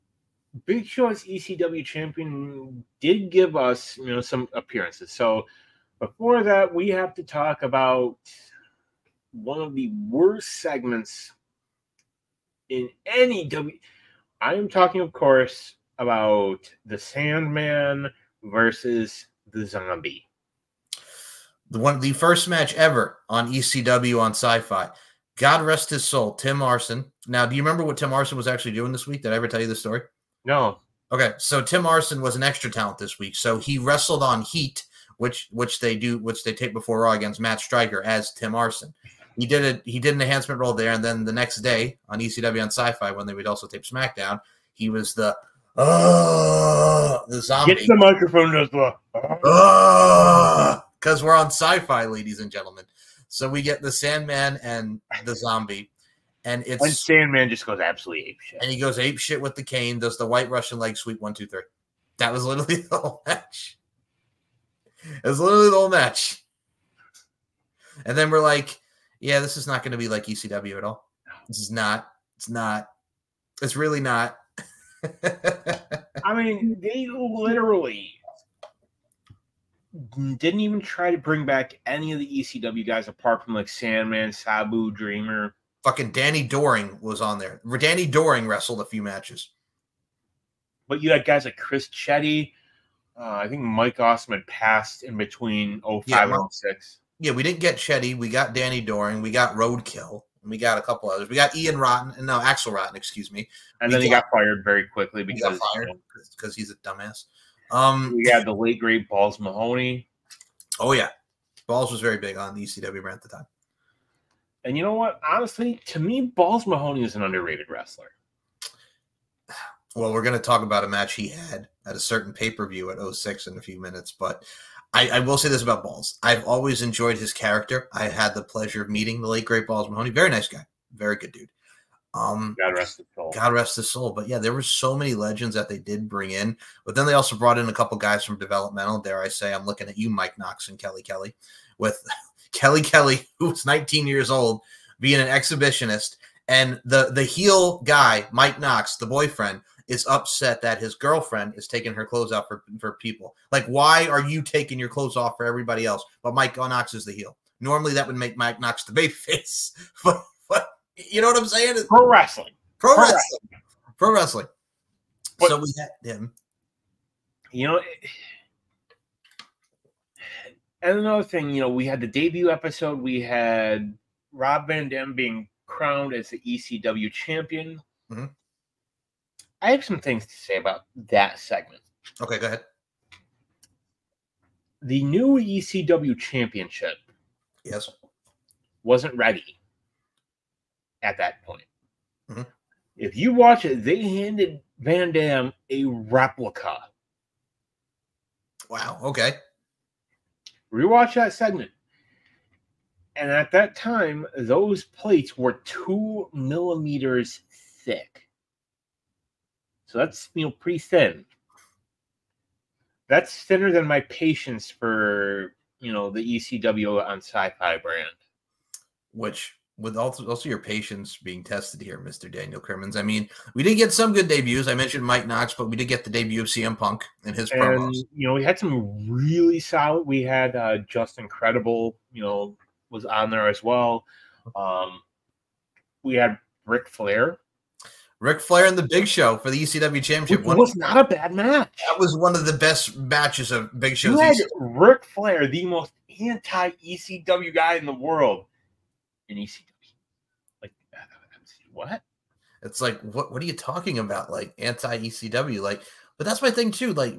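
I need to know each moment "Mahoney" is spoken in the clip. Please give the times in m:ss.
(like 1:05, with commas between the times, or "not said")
1:49, 1:56, 2:09.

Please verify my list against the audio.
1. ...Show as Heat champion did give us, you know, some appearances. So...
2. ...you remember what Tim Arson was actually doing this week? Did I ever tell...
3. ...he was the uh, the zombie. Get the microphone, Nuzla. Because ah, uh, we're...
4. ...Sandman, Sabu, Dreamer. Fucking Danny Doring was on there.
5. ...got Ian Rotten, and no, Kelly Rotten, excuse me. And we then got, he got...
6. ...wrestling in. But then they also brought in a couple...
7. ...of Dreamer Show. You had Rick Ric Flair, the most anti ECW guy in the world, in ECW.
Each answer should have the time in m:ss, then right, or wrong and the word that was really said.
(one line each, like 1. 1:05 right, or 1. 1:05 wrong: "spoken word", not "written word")
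1. 0:00 wrong: "ECW", not "Heat"
2. 0:27 right
3. 0:44 right
4. 1:23 right
5. 1:41 wrong: "Axel", not "Kelly"
6. 2:16 wrong: "bring", not "wrestling"
7. 4:03 wrong: "Big", not "Dreamer".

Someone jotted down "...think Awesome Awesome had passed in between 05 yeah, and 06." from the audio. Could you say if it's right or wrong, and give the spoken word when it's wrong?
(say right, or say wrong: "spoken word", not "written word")
wrong: "Mike", not "Awesome".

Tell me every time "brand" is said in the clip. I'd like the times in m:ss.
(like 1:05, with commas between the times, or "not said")
1:53, 3:37.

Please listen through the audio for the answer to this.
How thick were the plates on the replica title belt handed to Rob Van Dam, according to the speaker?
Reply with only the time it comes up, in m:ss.
3:25.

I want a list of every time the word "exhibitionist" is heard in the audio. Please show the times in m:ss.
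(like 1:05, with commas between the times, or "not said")
2:25.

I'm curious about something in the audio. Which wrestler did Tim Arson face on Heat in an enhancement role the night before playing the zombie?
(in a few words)
Matt Striker.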